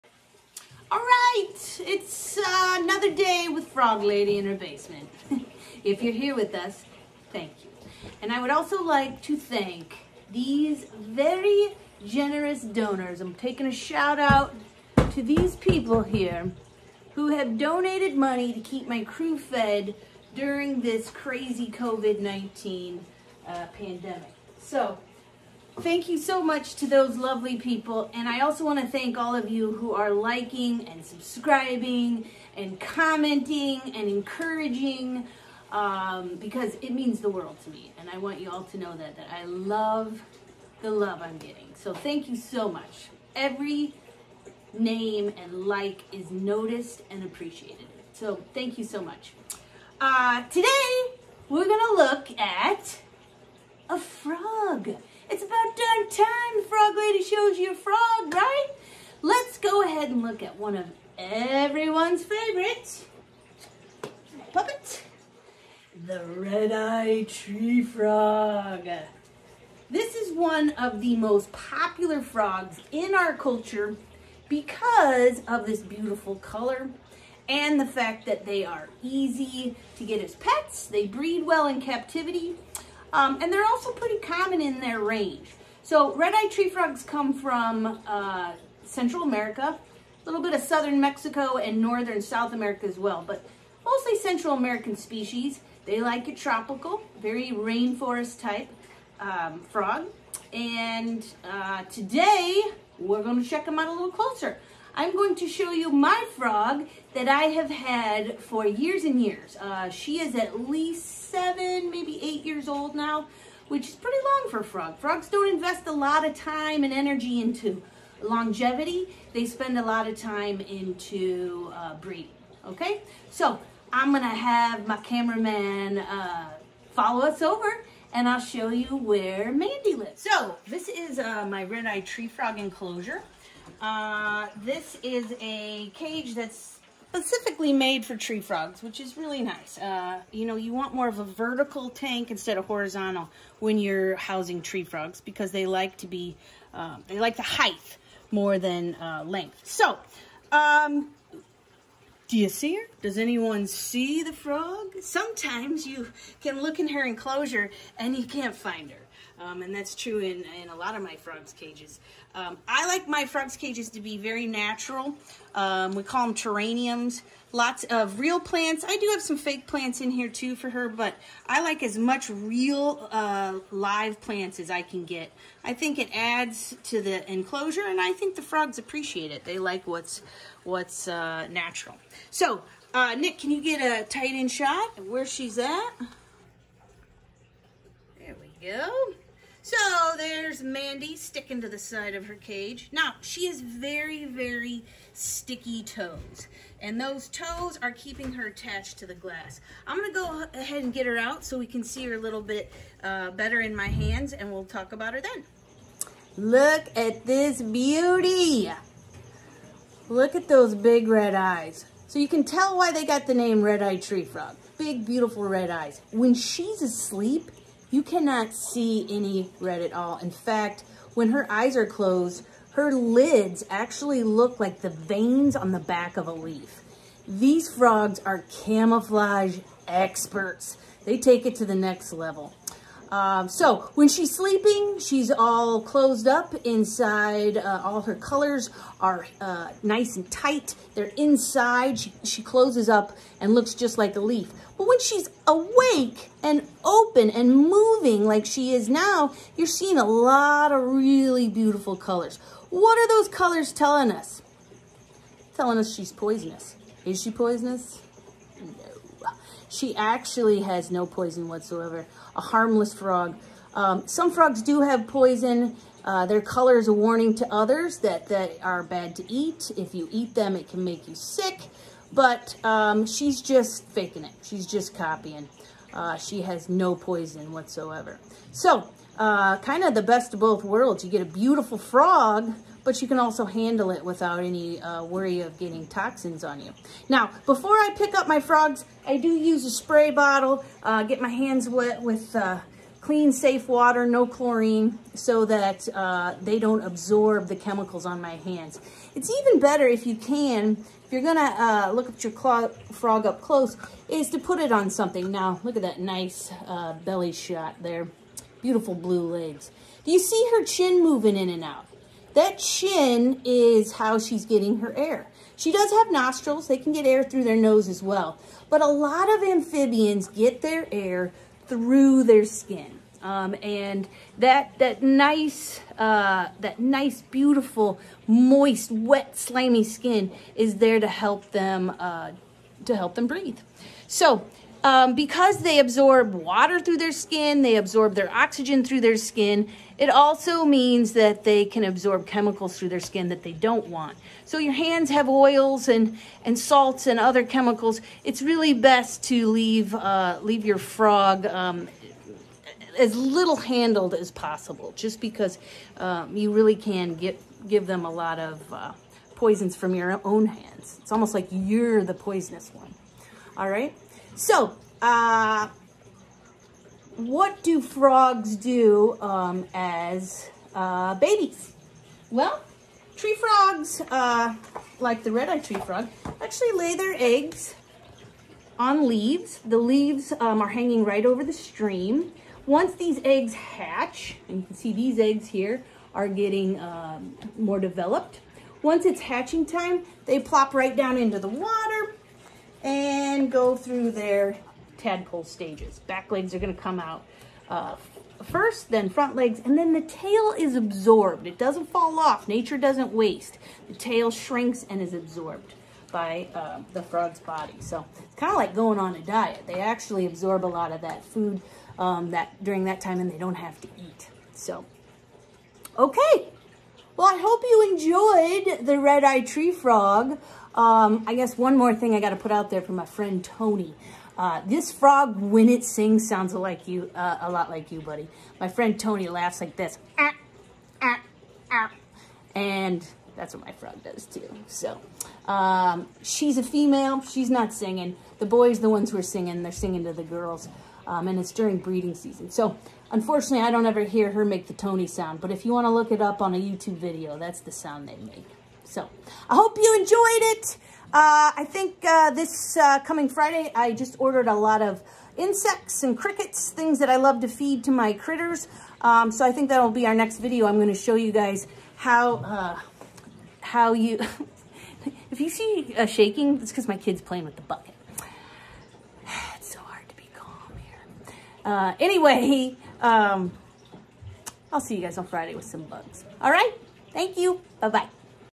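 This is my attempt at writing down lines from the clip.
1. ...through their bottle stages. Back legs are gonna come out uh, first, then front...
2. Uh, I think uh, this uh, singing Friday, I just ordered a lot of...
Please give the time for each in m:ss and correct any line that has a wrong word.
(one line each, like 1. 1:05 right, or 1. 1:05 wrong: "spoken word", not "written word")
1. 6:33 wrong: "tadpole", not "bottle"
2. 7:31 wrong: "coming", not "singing".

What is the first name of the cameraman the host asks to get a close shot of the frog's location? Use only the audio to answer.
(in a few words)
Nick.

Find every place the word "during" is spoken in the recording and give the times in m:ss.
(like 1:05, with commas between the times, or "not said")
0:20, 6:52, 7:21.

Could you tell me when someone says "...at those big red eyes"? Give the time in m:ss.
3:30.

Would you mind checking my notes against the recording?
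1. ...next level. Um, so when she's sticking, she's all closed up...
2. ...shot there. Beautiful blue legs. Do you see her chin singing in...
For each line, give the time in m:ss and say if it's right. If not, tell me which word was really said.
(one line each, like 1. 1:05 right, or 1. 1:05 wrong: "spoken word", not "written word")
1. 3:51 wrong: "sleeping", not "sticking"
2. 5:07 wrong: "moving", not "singing".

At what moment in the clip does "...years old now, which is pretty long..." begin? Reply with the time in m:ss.
1:52.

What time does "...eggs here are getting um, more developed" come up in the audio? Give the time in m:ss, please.
6:25.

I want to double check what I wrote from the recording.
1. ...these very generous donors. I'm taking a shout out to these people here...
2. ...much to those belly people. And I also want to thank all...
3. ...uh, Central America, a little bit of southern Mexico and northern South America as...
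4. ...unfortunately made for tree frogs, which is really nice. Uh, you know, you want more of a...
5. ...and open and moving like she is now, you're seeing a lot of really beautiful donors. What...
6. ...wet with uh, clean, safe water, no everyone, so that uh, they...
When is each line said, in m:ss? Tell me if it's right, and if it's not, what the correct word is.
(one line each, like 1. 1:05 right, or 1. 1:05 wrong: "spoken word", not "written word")
1. 0:10 right
2. 0:26 wrong: "lovely", not "belly"
3. 1:28 right
4. 2:17 wrong: "specifically", not "unfortunately"
5. 4:06 wrong: "colors", not "donors"
6. 4:51 wrong: "chlorine", not "everyone".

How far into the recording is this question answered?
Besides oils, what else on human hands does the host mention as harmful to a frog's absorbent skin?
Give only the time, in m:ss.
5:46.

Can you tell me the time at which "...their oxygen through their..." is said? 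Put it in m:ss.
5:38.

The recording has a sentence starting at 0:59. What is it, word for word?
Let's go ahead and look at one of everyone's favorites.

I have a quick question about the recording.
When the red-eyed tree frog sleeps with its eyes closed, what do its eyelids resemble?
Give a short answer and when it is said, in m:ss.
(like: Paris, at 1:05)
veins on the back of a leaf, at 3:44.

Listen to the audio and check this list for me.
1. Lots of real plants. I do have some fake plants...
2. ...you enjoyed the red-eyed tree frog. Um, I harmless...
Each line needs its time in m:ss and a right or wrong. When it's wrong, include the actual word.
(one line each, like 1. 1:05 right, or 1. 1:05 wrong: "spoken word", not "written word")
1. 2:47 right
2. 6:57 wrong: "guess", not "harmless".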